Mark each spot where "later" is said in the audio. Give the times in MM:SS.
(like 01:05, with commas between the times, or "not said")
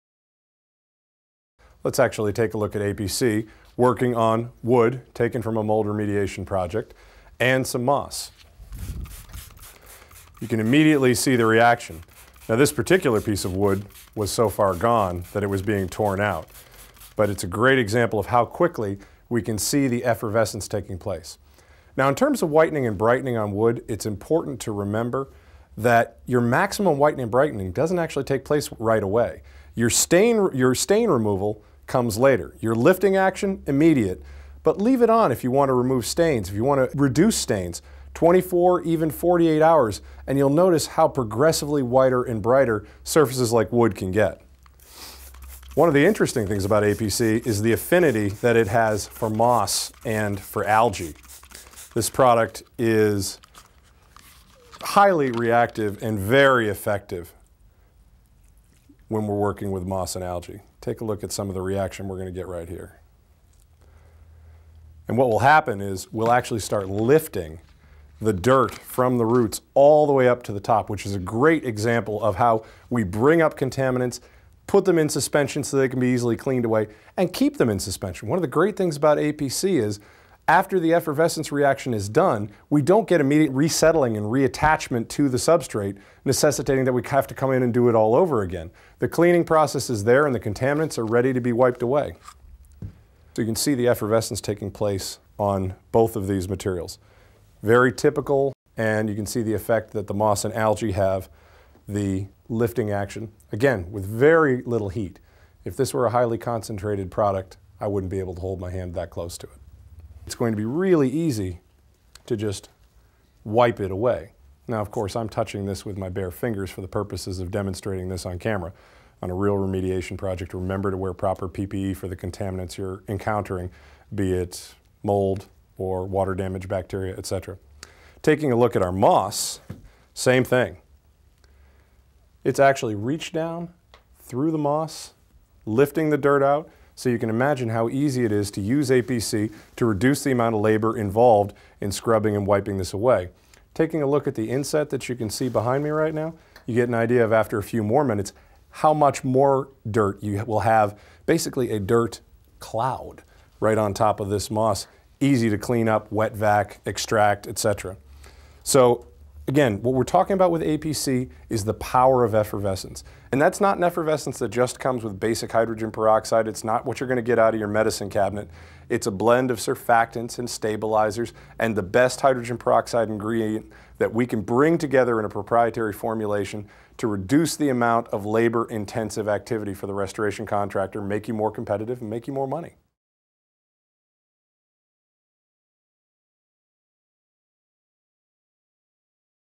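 00:32.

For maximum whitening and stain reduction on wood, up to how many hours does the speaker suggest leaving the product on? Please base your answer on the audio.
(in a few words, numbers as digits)
48 hours.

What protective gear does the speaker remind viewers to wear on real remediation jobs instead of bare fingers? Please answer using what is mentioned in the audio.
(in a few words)
PPE.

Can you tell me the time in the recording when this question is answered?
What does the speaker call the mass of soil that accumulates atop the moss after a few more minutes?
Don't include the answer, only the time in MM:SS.
02:31.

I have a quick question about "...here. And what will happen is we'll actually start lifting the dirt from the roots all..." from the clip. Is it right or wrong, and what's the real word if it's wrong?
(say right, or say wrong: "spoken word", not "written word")
right.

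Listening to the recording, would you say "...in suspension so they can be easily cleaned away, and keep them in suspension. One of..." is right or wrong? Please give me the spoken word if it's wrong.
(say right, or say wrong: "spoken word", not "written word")
right.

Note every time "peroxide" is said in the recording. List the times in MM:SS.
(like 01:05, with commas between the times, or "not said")
02:45, 02:52.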